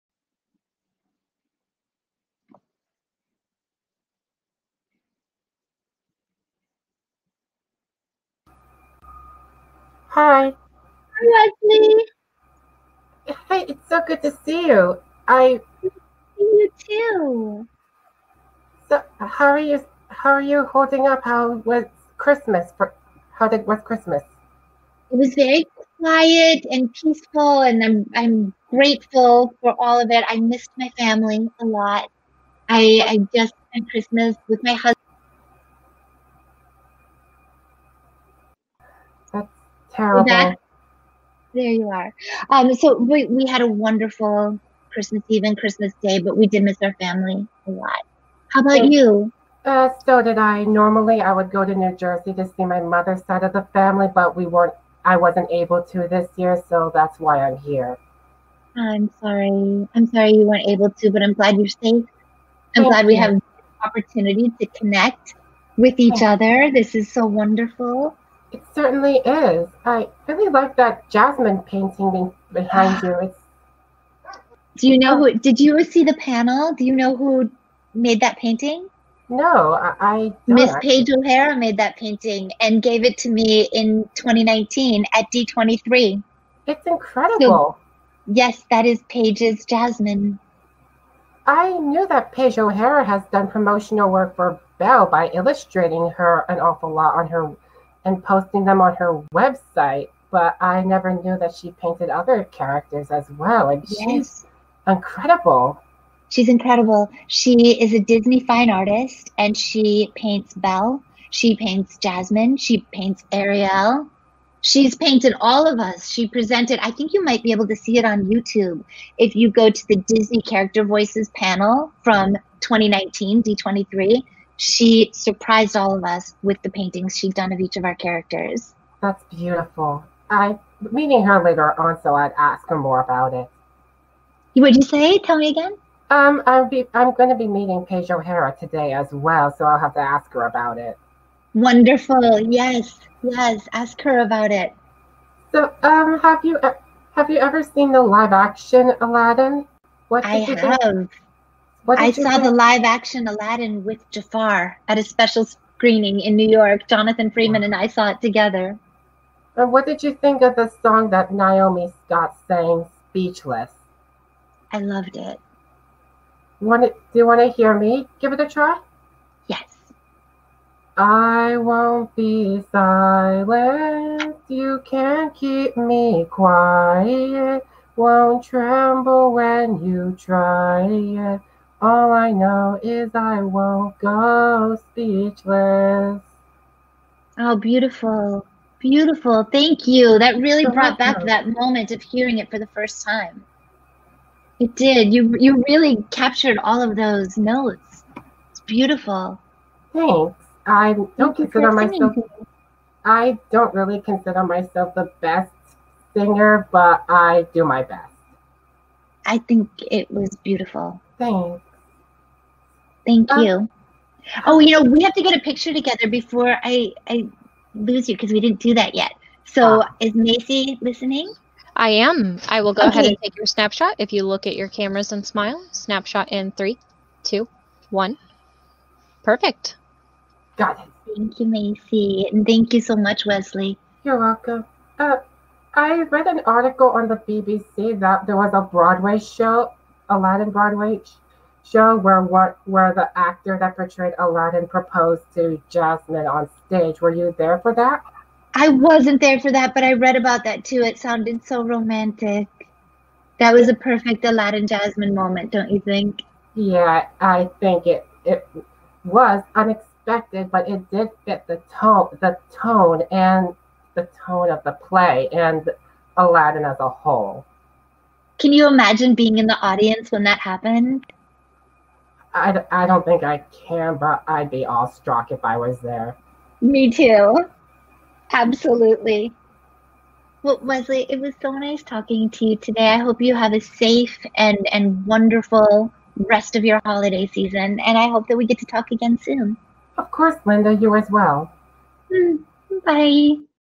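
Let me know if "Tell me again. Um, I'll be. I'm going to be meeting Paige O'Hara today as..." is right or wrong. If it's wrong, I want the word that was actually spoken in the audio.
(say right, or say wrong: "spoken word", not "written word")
right.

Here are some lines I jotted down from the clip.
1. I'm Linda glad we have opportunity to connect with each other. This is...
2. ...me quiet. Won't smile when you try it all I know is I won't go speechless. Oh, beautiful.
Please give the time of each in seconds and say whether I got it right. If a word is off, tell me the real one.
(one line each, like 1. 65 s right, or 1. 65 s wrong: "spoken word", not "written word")
1. 62 s wrong: "Thank", not "Linda"
2. 175 s wrong: "tremble", not "smile".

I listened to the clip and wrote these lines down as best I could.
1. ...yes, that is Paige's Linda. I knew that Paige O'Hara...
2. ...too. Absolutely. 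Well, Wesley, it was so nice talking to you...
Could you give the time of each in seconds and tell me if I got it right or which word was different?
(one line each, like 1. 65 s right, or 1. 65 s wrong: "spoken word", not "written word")
1. 88 s wrong: "Jasmine", not "Linda"
2. 276 s right.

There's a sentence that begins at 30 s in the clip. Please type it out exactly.
I missed my family a lot.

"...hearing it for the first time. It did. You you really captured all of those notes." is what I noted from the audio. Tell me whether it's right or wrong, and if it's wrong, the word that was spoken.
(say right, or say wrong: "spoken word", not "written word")
right.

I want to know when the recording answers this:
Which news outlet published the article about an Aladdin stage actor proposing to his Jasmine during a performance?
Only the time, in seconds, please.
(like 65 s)
237 s.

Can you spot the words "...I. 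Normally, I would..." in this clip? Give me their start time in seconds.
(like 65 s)
50 s.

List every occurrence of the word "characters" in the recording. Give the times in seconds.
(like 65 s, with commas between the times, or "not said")
102 s, 120 s, 127 s.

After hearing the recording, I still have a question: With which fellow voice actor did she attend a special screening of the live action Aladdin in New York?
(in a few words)
Jonathan Freeman.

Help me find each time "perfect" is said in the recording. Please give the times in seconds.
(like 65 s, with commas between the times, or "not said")
229 s, 253 s.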